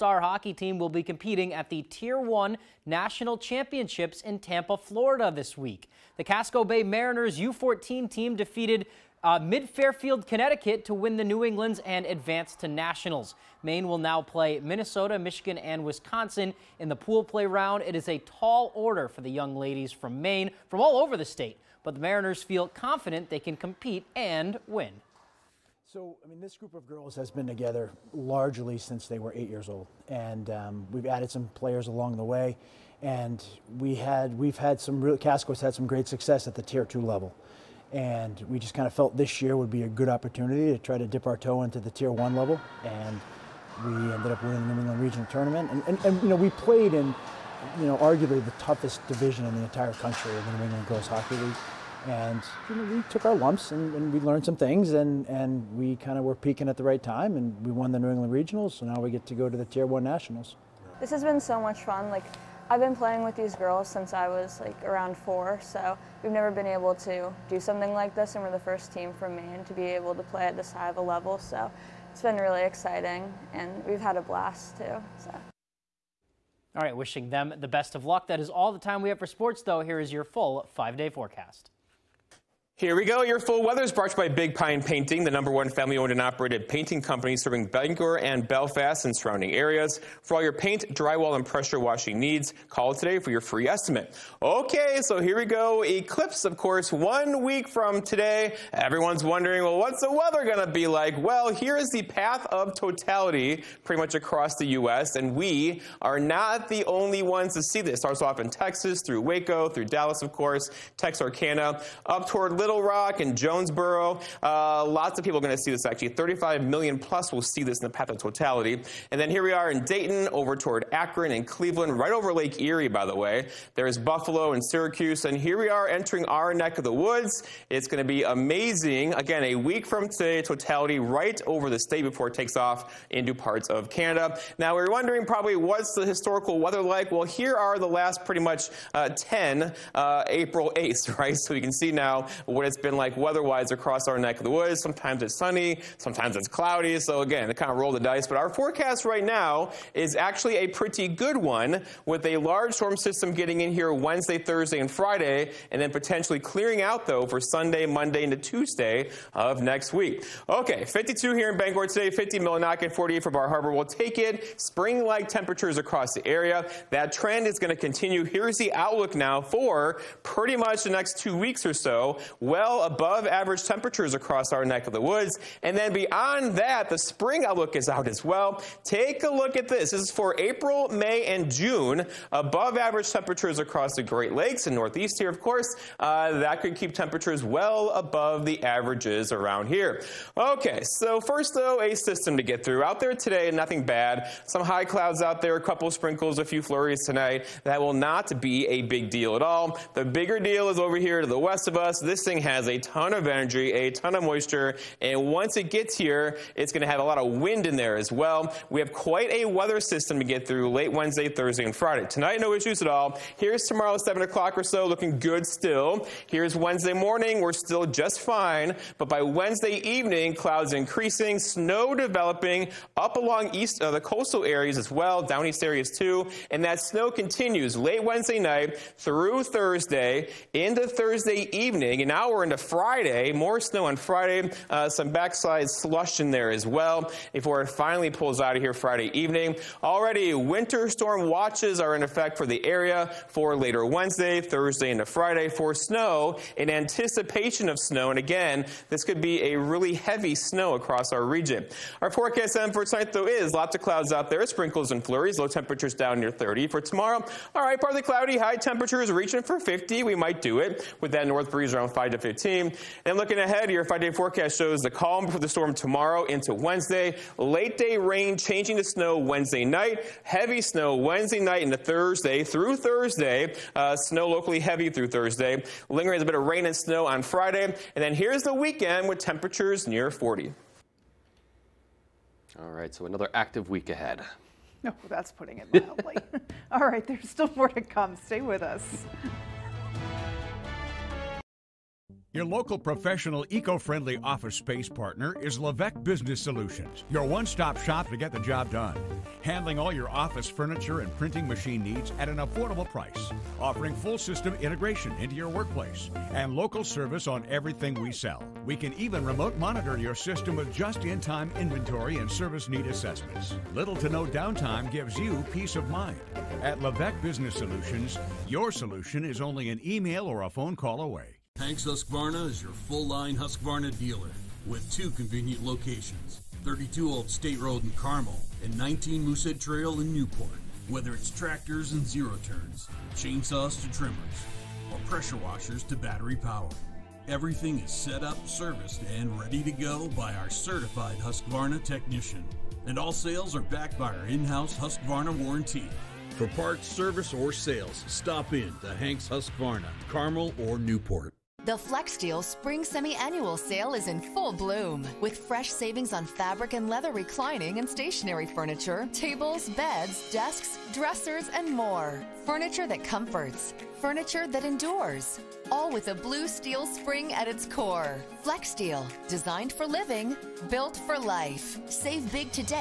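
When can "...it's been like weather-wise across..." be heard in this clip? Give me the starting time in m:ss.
2:22.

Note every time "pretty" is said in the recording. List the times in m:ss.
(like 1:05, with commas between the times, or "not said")
1:43, 2:18, 2:30, 2:50.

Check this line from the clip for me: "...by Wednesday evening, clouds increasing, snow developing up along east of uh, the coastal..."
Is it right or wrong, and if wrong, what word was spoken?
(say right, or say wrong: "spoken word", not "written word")
right.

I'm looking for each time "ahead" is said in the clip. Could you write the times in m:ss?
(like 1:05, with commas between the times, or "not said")
4:23, 4:43.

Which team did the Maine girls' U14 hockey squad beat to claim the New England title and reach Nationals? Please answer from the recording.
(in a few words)
Mid Fairfield, Connecticut.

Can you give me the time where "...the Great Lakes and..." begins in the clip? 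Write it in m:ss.
3:03.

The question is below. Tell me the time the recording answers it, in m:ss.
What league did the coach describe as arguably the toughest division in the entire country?
0:50.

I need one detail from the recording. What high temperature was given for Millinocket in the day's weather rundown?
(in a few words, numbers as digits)
50.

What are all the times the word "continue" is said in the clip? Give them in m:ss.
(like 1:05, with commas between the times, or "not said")
2:47, 3:47.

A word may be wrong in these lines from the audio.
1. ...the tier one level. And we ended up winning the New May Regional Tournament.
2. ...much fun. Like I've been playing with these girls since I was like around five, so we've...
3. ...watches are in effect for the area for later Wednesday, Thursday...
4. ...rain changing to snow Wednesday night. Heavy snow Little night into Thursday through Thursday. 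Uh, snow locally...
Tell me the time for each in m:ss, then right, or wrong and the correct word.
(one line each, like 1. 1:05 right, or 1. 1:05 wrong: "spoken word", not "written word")
1. 0:41 wrong: "England", not "May"
2. 1:01 wrong: "four", not "five"
3. 4:01 right
4. 4:27 wrong: "Wednesday", not "Little".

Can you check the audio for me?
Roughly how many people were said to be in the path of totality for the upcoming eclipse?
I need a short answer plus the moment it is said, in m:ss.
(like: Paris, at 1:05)
35 million plus, at 1:56.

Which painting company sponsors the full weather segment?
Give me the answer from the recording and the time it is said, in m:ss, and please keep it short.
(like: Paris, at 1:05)
Big Pine Painting, at 1:24.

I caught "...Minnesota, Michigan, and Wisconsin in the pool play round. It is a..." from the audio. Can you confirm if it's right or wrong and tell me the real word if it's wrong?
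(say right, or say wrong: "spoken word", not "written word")
right.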